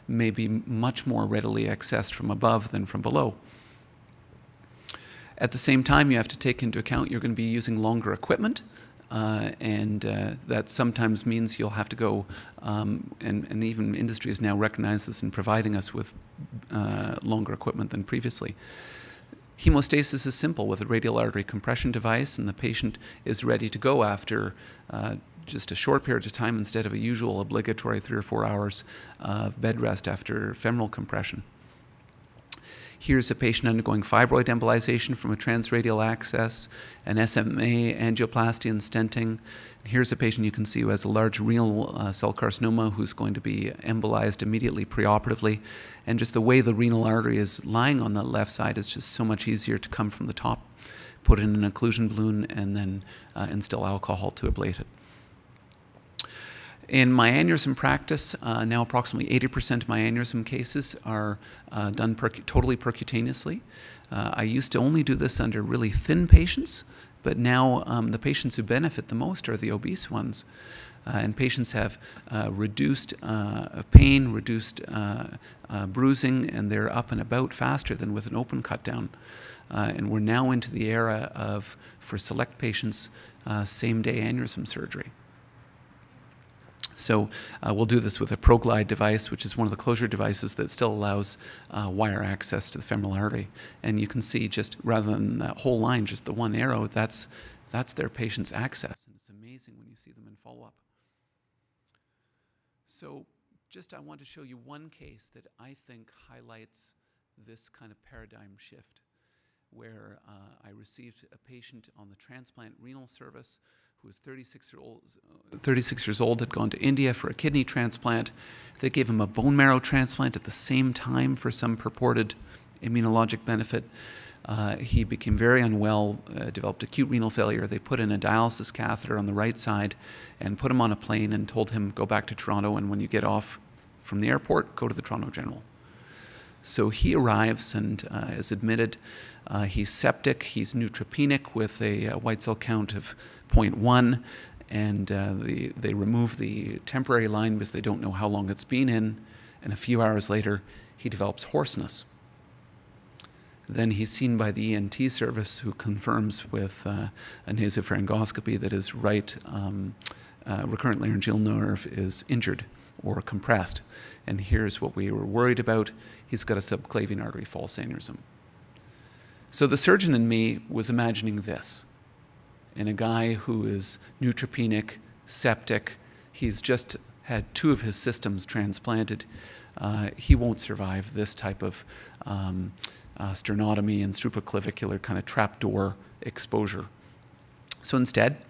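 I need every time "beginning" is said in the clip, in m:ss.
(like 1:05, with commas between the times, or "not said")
not said.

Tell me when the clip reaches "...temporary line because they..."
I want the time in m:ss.
2:26.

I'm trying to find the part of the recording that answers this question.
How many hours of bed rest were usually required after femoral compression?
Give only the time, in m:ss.
0:27.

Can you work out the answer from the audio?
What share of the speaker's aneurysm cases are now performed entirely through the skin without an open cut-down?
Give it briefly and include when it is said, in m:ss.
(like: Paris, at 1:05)
80%, at 0:59.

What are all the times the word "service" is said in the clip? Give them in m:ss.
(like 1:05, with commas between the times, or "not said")
1:53, 2:35.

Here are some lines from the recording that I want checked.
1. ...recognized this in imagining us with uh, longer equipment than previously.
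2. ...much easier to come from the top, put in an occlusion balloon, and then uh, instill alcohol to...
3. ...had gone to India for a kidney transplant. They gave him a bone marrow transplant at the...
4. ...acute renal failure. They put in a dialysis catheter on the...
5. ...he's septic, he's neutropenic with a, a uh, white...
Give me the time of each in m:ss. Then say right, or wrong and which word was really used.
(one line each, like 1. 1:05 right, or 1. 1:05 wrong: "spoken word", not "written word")
1. 0:14 wrong: "providing", not "imagining"
2. 0:49 right
3. 1:56 right
4. 2:06 right
5. 2:19 right.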